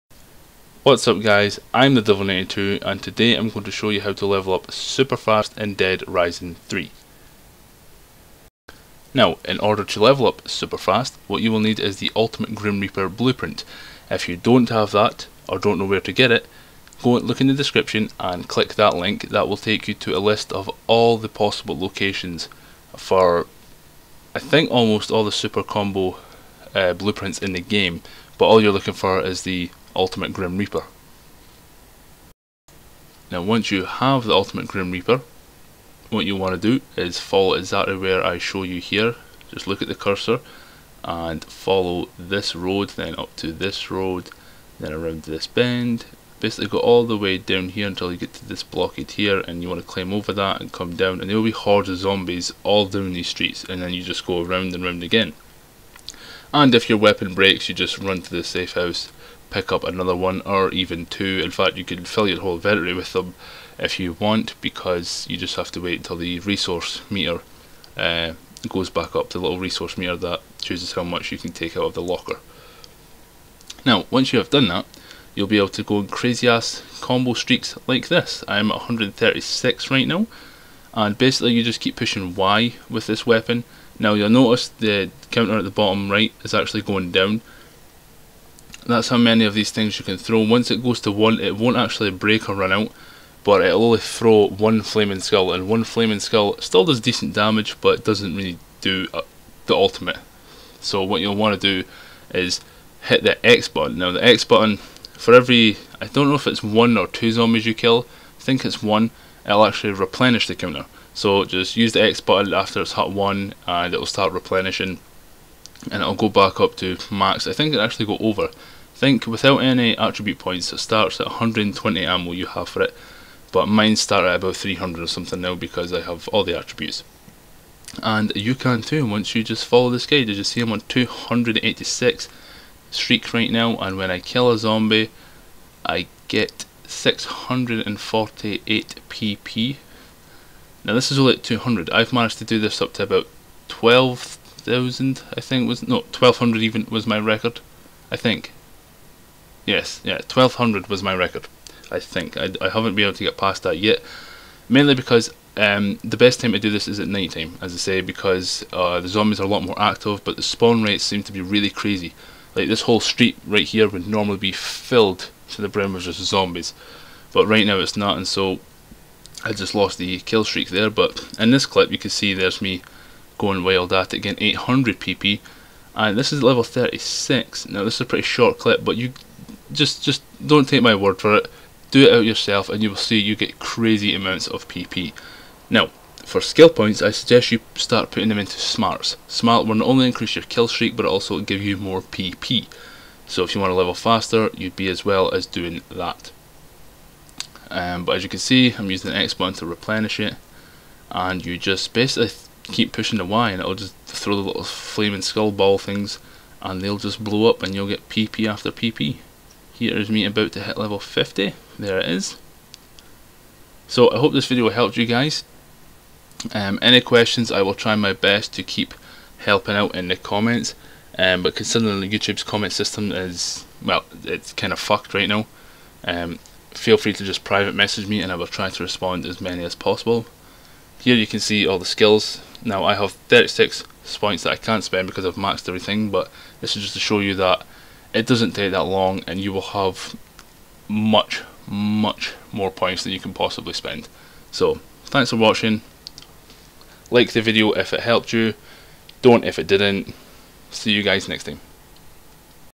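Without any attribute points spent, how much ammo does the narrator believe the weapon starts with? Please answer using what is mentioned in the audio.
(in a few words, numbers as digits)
120.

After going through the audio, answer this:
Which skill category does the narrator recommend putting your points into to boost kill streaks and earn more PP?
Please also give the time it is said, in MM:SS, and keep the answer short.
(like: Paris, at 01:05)
Smarts, at 03:08.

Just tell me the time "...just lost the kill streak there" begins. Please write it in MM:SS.
02:49.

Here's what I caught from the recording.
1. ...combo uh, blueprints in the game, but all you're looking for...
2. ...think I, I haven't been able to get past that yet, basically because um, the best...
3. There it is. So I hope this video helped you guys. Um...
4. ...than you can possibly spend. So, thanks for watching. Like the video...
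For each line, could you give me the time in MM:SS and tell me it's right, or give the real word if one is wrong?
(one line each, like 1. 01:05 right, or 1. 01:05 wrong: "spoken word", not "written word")
1. 00:25 right
2. 02:31 wrong: "mainly", not "basically"
3. 03:31 right
4. 04:03 right.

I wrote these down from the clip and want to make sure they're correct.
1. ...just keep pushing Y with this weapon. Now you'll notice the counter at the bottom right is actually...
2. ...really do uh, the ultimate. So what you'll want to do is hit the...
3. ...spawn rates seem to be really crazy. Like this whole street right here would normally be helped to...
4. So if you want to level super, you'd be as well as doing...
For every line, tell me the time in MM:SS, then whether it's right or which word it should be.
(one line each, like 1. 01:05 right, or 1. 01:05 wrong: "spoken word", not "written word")
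1. 01:21 right
2. 01:38 right
3. 02:40 wrong: "filled", not "helped"
4. 03:13 wrong: "faster", not "super".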